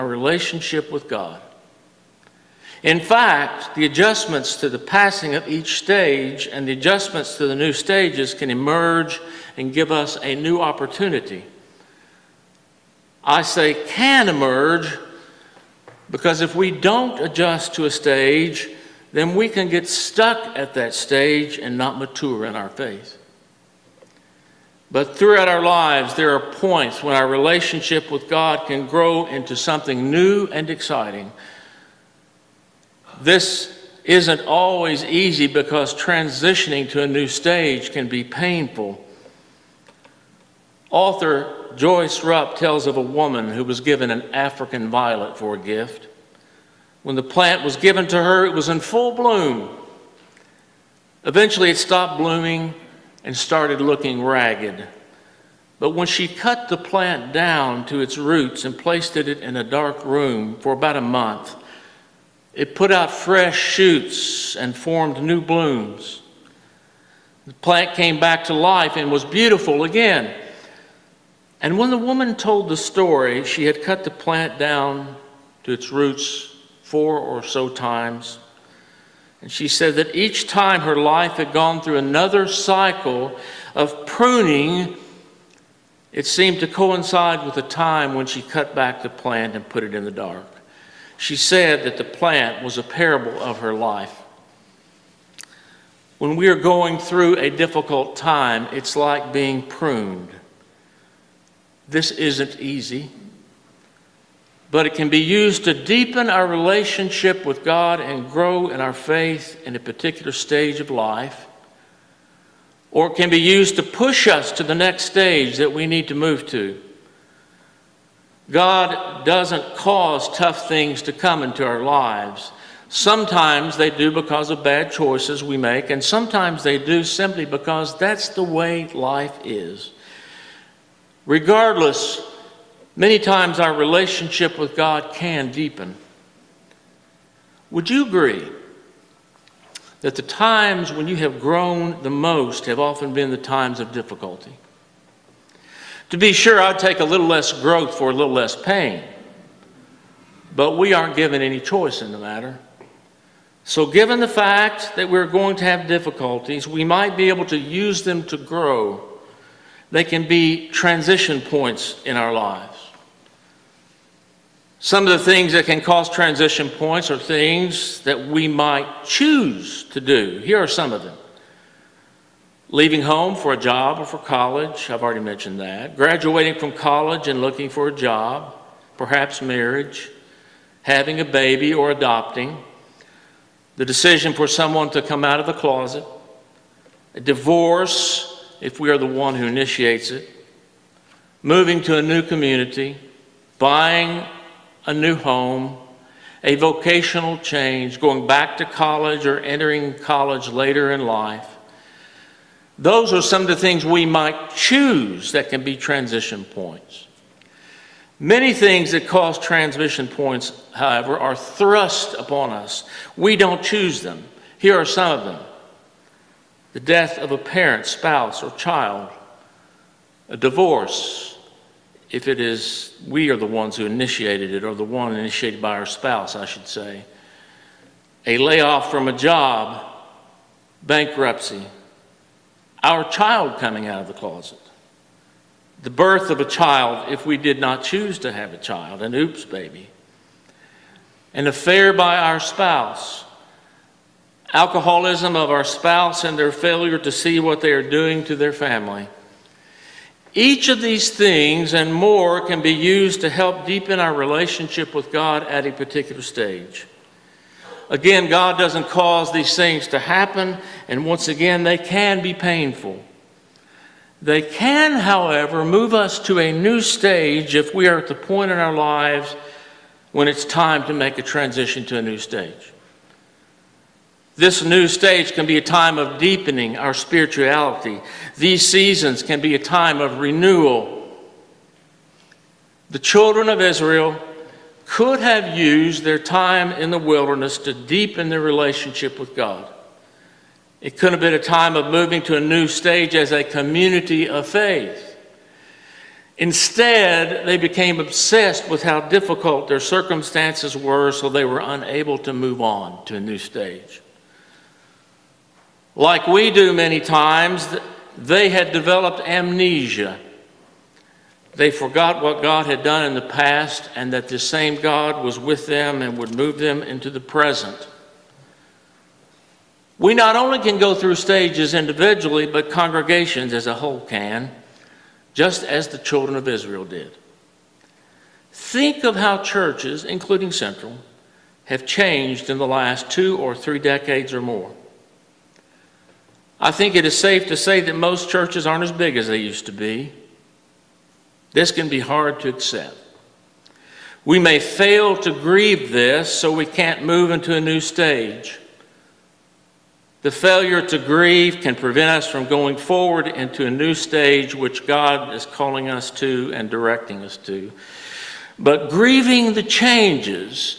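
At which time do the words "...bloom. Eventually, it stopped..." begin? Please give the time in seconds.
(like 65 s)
49 s.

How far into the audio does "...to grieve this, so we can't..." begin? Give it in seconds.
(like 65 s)
345 s.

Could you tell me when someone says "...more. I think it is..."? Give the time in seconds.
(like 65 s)
334 s.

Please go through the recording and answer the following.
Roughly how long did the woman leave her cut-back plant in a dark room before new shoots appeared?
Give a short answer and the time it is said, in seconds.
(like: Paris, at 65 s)
about a month, at 60 s.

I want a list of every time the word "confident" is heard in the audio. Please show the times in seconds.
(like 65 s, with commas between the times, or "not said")
not said.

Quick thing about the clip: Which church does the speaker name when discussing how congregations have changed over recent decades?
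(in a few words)
Central.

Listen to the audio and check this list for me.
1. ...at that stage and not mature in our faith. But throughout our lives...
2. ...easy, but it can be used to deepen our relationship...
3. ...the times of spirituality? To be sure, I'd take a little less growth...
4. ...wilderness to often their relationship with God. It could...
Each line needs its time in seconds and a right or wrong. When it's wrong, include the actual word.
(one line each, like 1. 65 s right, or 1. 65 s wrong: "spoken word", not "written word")
1. 20 s right
2. 102 s right
3. 143 s wrong: "difficulty", not "spirituality"
4. 286 s wrong: "deepen", not "often".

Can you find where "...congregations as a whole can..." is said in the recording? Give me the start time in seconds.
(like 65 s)
322 s.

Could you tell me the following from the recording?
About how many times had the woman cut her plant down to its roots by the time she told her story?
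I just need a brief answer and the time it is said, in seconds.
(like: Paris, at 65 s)
4, at 76 s.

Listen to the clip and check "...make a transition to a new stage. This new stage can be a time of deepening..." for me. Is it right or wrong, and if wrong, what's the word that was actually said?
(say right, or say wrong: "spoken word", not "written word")
right.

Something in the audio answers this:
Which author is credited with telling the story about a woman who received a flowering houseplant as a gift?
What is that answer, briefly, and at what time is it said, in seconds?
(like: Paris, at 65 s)
Joyce Rupp, at 41 s.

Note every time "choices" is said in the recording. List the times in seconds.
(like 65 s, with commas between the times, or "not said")
124 s, 151 s.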